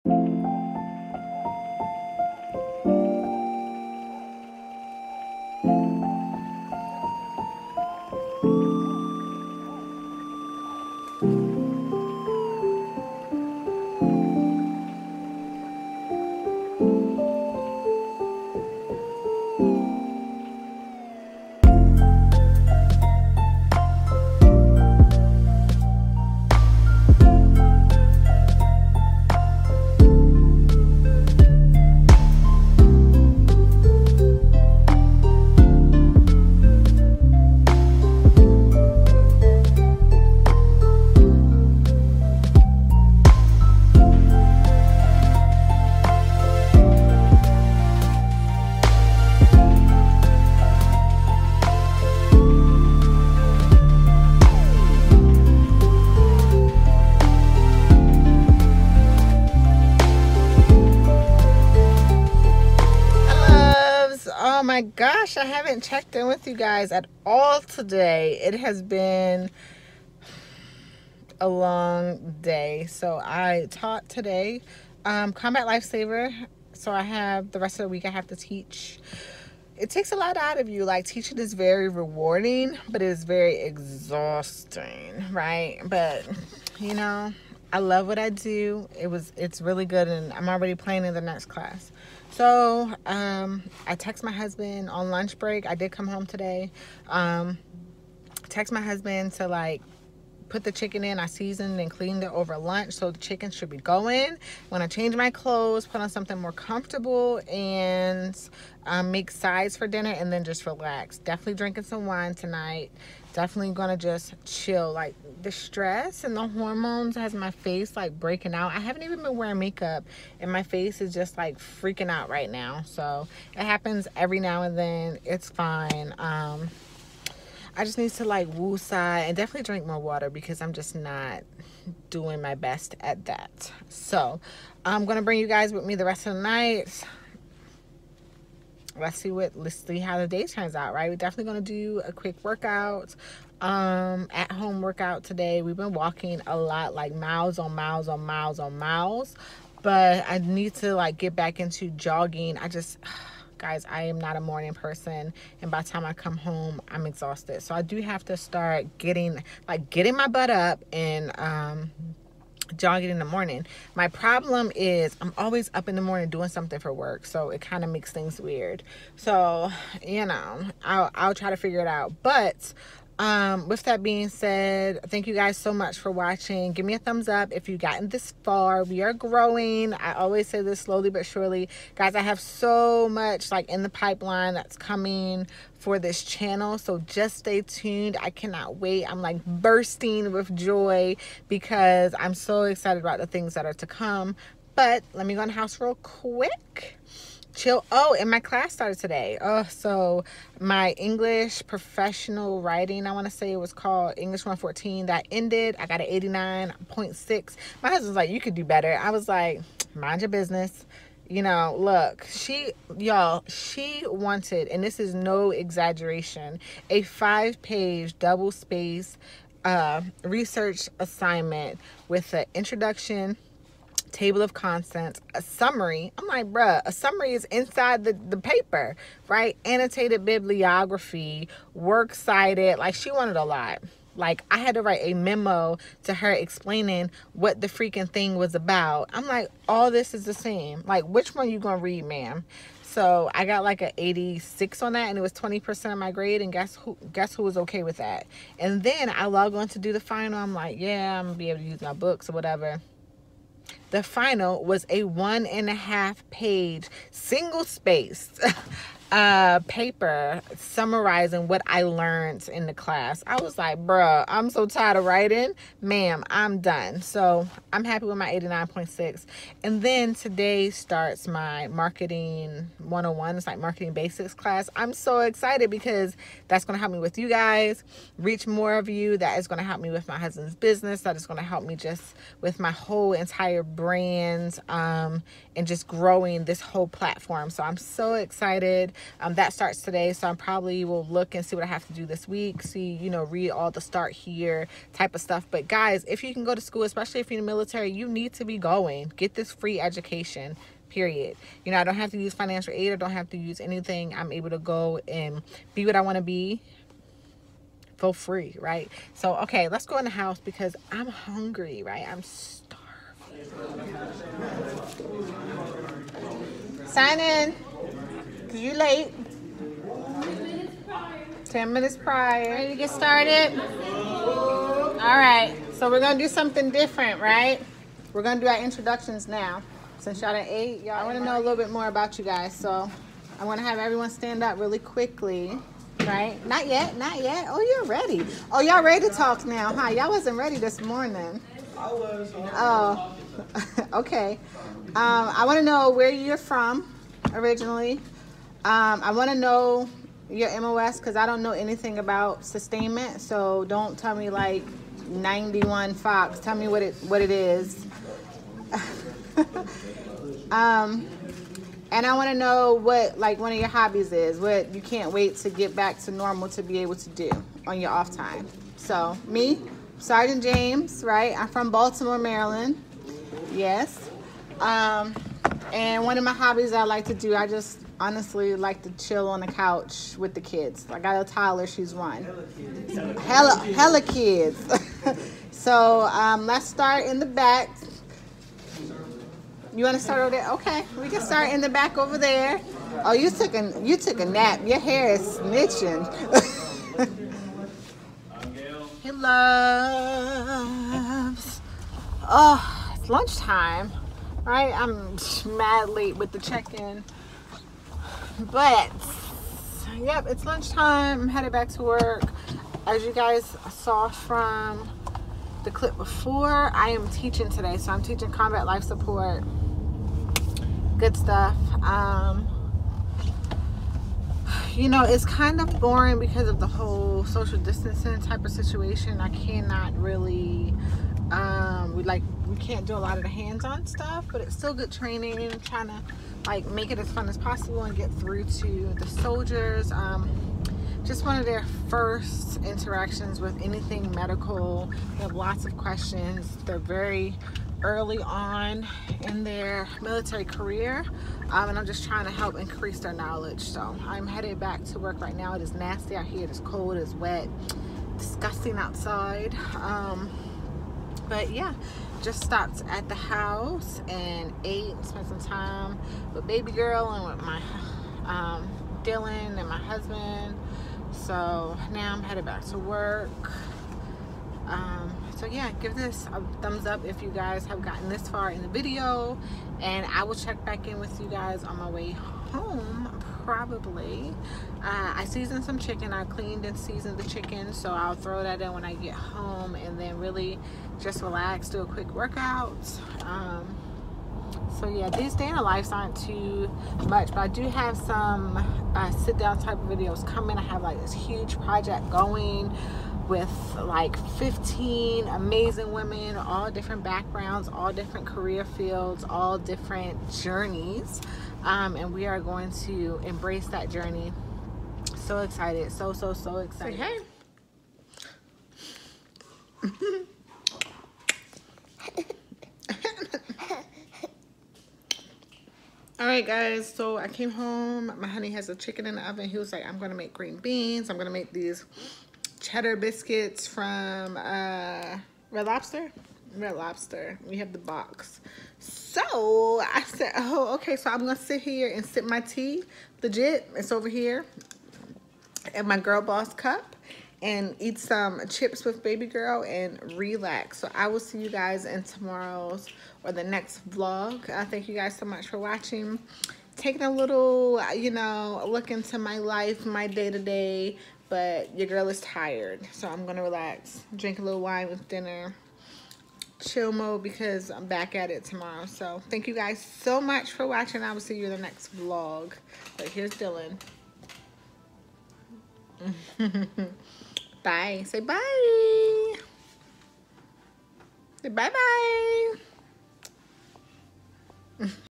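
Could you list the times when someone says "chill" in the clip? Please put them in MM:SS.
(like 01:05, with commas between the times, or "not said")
01:54, 03:17, 06:18, 09:26.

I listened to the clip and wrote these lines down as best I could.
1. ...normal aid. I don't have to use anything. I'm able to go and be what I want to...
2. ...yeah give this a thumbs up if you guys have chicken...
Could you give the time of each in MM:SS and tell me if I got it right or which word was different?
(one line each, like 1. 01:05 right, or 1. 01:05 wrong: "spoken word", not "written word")
1. 05:02 wrong: "financial", not "normal"
2. 07:55 wrong: "gotten", not "chicken".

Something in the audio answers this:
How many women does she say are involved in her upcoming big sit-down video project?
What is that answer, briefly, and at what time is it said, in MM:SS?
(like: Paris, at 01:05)
15, at 08:24.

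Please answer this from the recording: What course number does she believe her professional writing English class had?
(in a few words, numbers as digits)
English 114.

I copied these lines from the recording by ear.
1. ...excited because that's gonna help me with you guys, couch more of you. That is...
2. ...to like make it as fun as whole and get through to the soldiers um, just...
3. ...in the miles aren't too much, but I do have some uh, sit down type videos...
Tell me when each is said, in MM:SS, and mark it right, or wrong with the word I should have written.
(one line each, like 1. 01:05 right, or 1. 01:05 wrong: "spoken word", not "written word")
1. 04:35 wrong: "reach", not "couch"
2. 07:15 wrong: "possible", not "whole"
3. 08:15 wrong: "lives", not "miles".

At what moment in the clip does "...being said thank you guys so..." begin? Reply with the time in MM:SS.
02:54.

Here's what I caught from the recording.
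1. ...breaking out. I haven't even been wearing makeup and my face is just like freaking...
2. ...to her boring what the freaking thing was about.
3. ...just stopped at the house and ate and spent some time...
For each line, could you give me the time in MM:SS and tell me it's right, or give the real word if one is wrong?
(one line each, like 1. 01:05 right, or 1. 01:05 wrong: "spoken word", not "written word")
1. 01:58 right
2. 03:56 wrong: "explaining", not "boring"
3. 07:42 right.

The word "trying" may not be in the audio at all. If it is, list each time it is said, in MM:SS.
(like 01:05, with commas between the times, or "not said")
07:15, 07:32.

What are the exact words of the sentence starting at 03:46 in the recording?
I'm like, bruh, a summary is inside the, the paper, right?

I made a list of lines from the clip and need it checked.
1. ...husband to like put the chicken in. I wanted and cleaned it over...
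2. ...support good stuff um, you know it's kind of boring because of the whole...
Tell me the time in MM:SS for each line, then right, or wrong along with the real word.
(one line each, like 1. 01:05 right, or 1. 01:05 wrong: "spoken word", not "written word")
1. 01:38 wrong: "seasoned", not "wanted"
2. 06:58 right.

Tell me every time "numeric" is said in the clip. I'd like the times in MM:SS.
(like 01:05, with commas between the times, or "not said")
not said.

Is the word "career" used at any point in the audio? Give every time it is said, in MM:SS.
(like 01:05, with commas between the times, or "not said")
07:30, 08:28.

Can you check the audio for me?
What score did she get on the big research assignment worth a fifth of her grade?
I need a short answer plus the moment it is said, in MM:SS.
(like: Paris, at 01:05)
86, at 04:03.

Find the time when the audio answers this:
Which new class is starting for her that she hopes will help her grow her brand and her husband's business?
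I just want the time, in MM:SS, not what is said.
04:31.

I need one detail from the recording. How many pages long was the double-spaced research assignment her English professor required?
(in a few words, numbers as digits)
5.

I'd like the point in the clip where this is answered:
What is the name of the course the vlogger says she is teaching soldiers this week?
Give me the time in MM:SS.
01:15.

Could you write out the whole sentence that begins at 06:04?
What you can't wait to get back to normal to be able to do on your off time.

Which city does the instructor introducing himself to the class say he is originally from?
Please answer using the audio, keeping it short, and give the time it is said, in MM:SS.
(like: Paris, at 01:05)
Baltimore, Maryland, at 06:11.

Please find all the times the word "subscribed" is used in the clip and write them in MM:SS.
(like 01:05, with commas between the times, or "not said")
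not said.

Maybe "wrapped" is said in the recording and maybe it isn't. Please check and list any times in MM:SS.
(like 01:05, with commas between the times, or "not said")
not said.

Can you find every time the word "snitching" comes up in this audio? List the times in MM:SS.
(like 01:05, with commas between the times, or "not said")
06:35.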